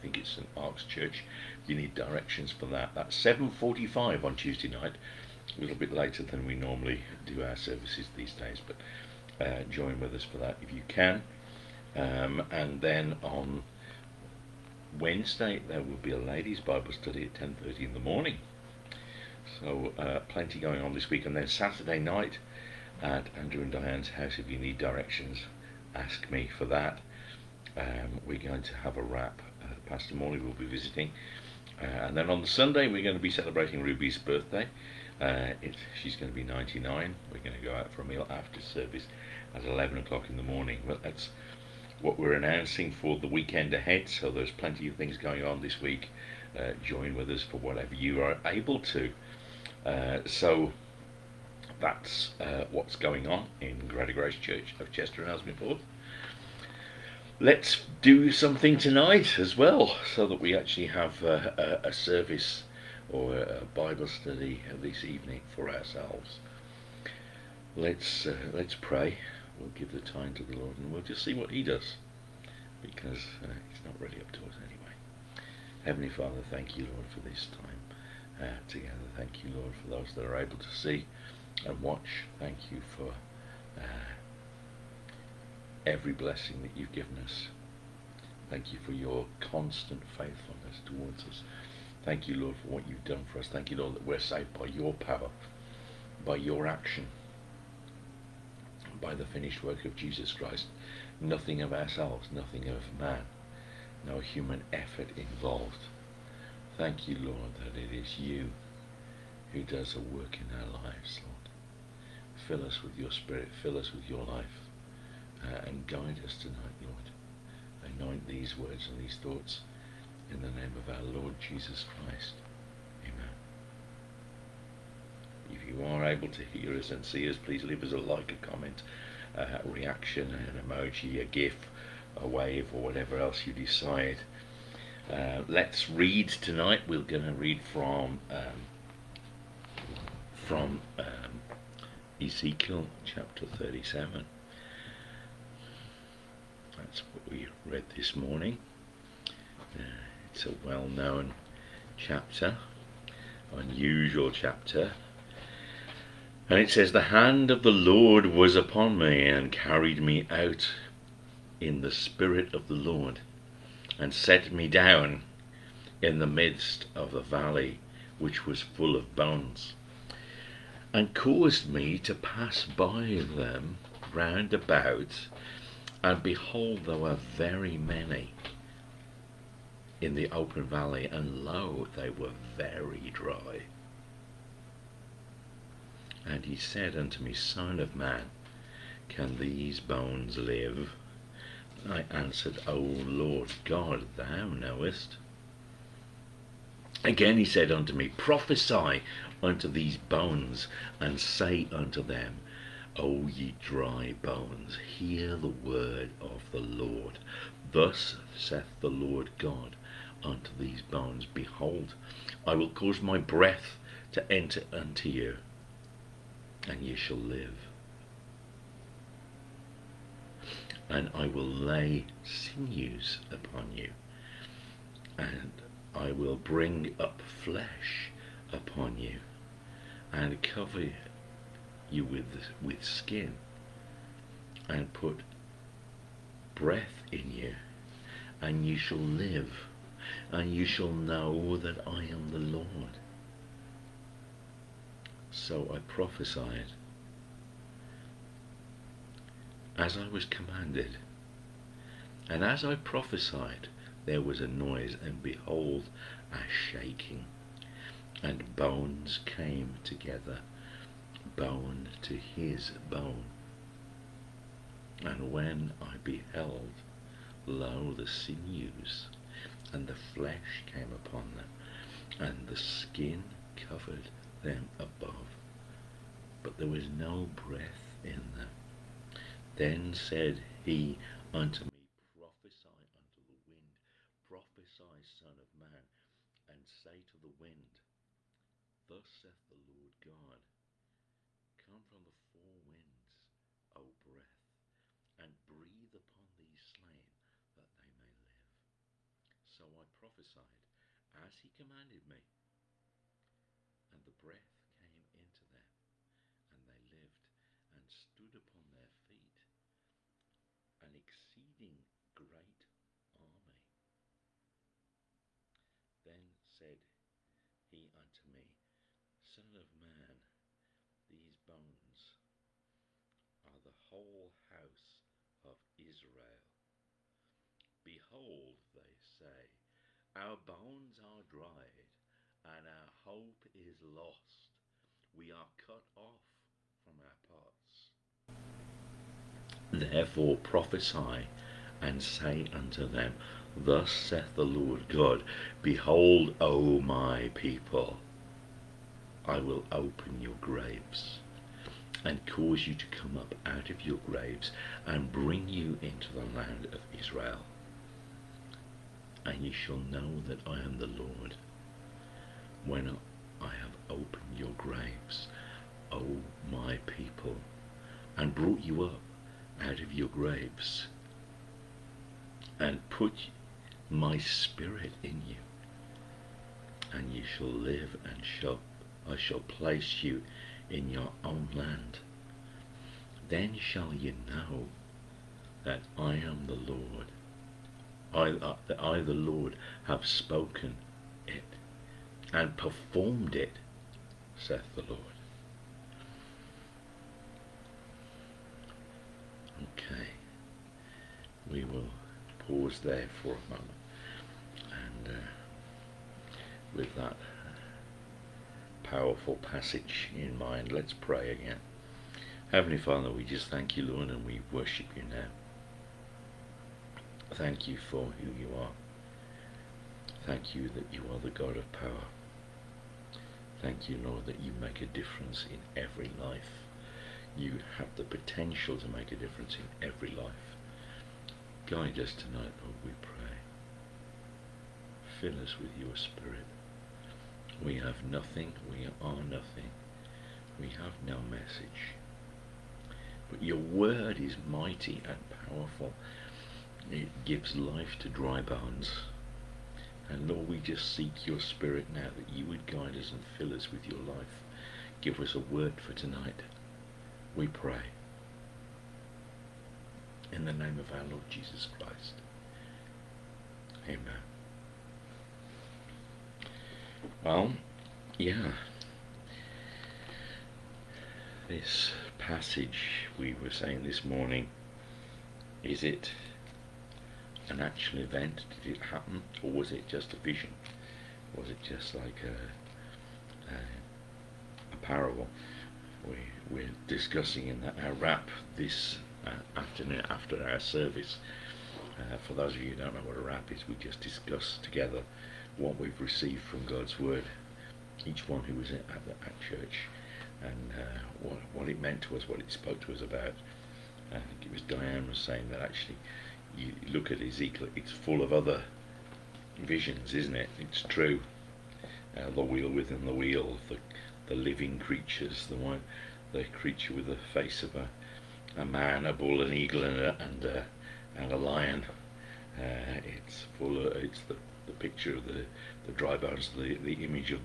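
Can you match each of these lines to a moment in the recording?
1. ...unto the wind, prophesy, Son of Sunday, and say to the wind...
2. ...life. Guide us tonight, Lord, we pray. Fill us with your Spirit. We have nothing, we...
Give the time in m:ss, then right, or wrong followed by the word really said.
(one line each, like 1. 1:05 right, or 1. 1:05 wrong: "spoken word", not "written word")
1. 4:42 wrong: "Man", not "Sunday"
2. 7:10 right.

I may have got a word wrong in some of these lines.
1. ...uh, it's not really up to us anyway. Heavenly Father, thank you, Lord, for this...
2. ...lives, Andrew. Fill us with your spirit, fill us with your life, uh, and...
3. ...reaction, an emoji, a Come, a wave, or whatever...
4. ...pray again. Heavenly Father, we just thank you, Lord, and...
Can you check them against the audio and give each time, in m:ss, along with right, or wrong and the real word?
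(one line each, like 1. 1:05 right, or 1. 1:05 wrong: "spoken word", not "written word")
1. 1:13 right
2. 1:50 wrong: "Lord", not "Andrew"
3. 2:09 wrong: "GIF", not "Come"
4. 6:50 right.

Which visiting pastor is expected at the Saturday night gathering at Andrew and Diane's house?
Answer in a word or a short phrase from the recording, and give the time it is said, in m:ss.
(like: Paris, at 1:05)
Pastor Morley, at 0:29.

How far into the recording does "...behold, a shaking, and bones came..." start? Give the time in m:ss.
4:15.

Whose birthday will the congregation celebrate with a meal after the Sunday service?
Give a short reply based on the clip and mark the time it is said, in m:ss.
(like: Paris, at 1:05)
Ruby, at 0:33.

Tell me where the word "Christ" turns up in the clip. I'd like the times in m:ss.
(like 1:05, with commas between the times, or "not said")
1:40, 2:02, 7:41.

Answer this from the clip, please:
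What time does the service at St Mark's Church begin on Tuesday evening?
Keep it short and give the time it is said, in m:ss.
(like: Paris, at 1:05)
7:45, at 0:03.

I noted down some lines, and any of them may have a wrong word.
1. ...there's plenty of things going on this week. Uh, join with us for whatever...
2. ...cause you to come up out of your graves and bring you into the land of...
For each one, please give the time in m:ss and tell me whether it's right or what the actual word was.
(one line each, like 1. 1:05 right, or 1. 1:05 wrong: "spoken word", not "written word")
1. 0:44 right
2. 5:52 right.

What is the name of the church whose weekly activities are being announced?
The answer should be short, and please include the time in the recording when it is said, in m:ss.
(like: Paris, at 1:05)
Greater Grace Church, at 0:53.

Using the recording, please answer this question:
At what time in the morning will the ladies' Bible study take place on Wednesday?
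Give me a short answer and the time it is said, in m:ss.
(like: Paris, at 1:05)
10:30, at 0:17.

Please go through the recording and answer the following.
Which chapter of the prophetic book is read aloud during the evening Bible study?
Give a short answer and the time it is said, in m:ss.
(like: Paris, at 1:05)
37, at 2:23.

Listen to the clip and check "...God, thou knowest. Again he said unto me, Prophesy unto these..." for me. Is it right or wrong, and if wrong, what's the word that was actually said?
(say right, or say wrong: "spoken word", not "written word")
right.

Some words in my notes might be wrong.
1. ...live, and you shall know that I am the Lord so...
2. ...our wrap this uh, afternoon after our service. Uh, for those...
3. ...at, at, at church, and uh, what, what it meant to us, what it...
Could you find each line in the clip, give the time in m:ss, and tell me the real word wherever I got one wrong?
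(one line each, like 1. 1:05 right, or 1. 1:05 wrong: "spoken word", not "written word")
1. 3:58 right
2. 8:07 right
3. 8:18 right.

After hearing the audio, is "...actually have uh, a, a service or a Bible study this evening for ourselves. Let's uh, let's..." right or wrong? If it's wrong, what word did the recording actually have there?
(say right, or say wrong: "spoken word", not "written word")
right.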